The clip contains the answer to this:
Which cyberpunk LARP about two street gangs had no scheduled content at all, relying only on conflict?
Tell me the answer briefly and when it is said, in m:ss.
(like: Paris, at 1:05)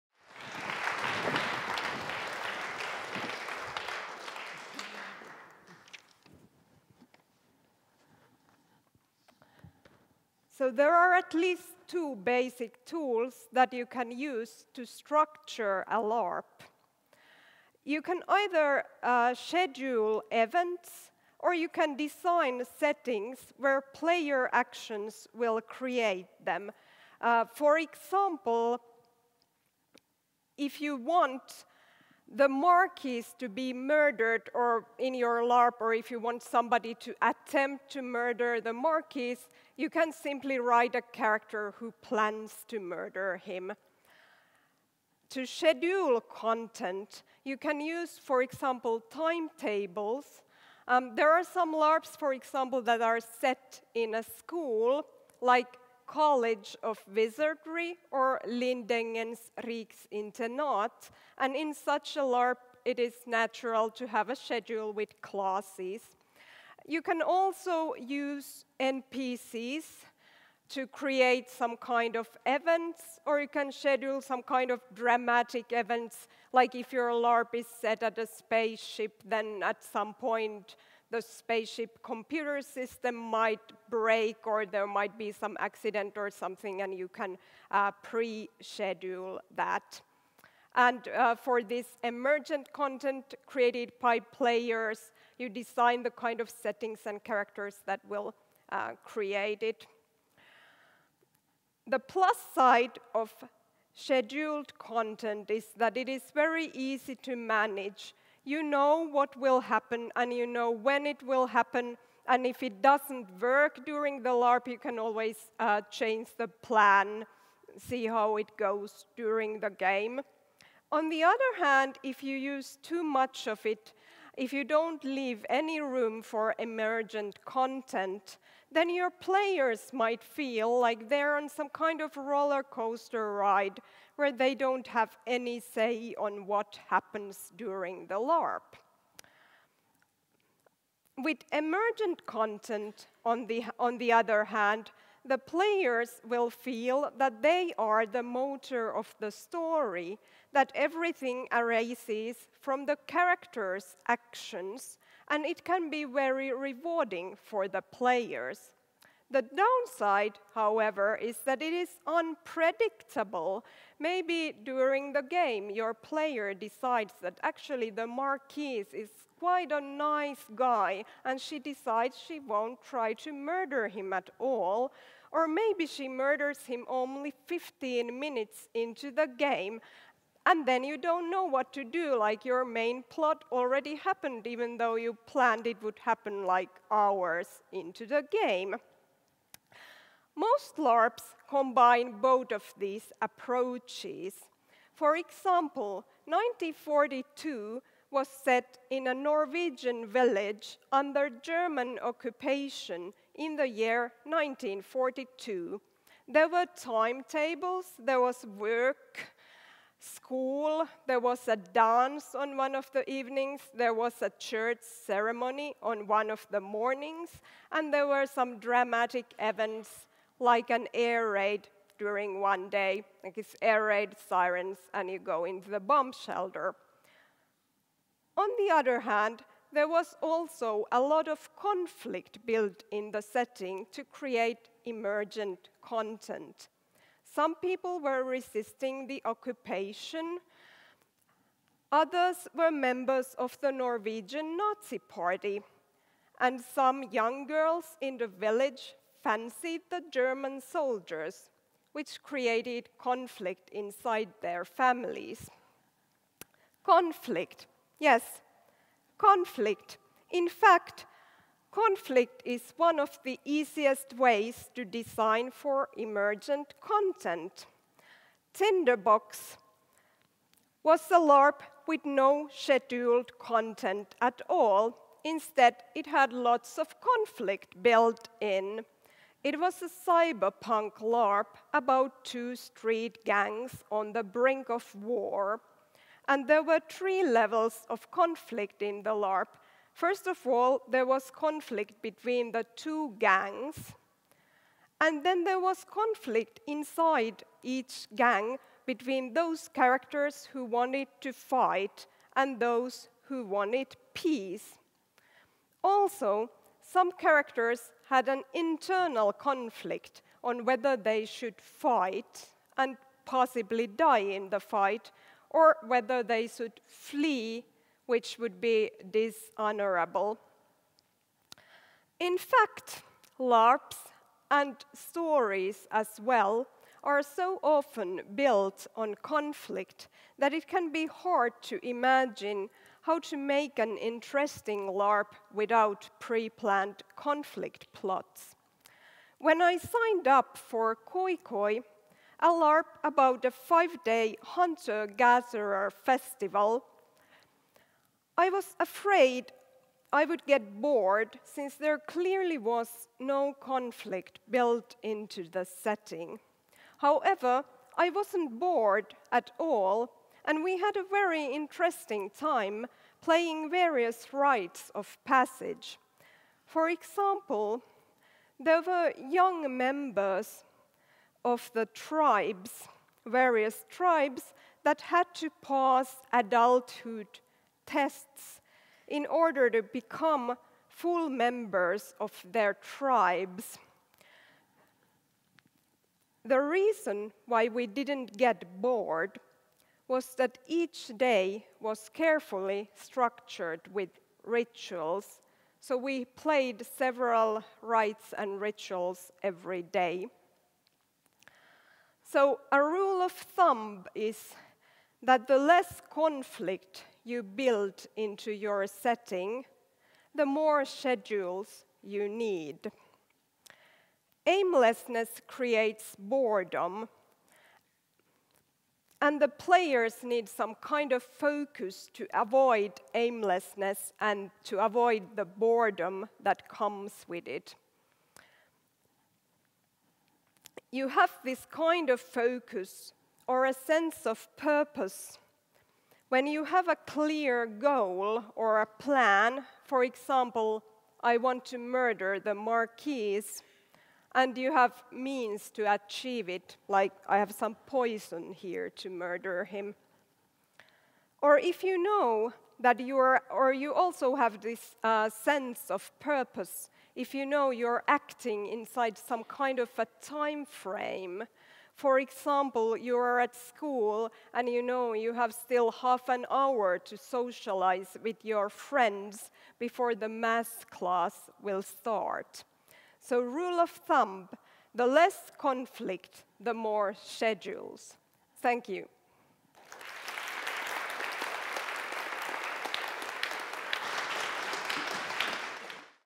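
Tinderbox, at 4:28.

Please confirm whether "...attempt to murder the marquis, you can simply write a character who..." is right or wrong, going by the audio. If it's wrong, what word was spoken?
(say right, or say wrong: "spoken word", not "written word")
right.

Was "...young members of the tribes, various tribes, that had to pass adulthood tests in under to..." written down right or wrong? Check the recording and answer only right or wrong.
wrong.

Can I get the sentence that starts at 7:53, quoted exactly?
So, rule of thumb the less conflict, the more schedules.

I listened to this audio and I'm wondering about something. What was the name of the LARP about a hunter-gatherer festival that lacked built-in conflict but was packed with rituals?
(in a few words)
Koi Koi.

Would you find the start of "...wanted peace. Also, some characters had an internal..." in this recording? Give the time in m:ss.
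5:03.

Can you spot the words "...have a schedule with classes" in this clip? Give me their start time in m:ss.
1:04.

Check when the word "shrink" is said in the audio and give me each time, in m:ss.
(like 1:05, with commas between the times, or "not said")
not said.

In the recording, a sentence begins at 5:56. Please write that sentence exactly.
However, I wasn't bored at all, and we had a very interesting time playing various rites of passage.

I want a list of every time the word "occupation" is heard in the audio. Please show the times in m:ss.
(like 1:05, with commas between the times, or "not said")
3:22, 3:59.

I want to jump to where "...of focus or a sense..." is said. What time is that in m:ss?
7:12.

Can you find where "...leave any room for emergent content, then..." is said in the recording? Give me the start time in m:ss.
2:05.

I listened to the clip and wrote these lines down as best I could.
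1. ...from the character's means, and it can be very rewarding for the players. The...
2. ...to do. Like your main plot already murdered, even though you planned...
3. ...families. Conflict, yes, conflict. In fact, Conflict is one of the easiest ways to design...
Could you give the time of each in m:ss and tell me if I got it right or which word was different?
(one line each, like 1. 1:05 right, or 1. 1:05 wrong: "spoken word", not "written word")
1. 2:32 wrong: "actions", not "means"
2. 3:01 wrong: "happened", not "murdered"
3. 4:14 right.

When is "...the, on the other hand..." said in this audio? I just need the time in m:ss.
2:23.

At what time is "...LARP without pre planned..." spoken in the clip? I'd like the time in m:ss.
5:34.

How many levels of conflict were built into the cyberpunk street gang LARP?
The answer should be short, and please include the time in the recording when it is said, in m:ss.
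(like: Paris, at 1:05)
3, at 4:46.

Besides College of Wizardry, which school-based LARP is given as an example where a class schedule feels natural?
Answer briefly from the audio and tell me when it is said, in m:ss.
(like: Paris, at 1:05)
Lindängens Riksinternat, at 0:58.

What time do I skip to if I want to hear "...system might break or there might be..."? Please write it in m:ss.
1:22.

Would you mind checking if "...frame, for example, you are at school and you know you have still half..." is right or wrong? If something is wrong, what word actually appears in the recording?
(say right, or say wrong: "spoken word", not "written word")
right.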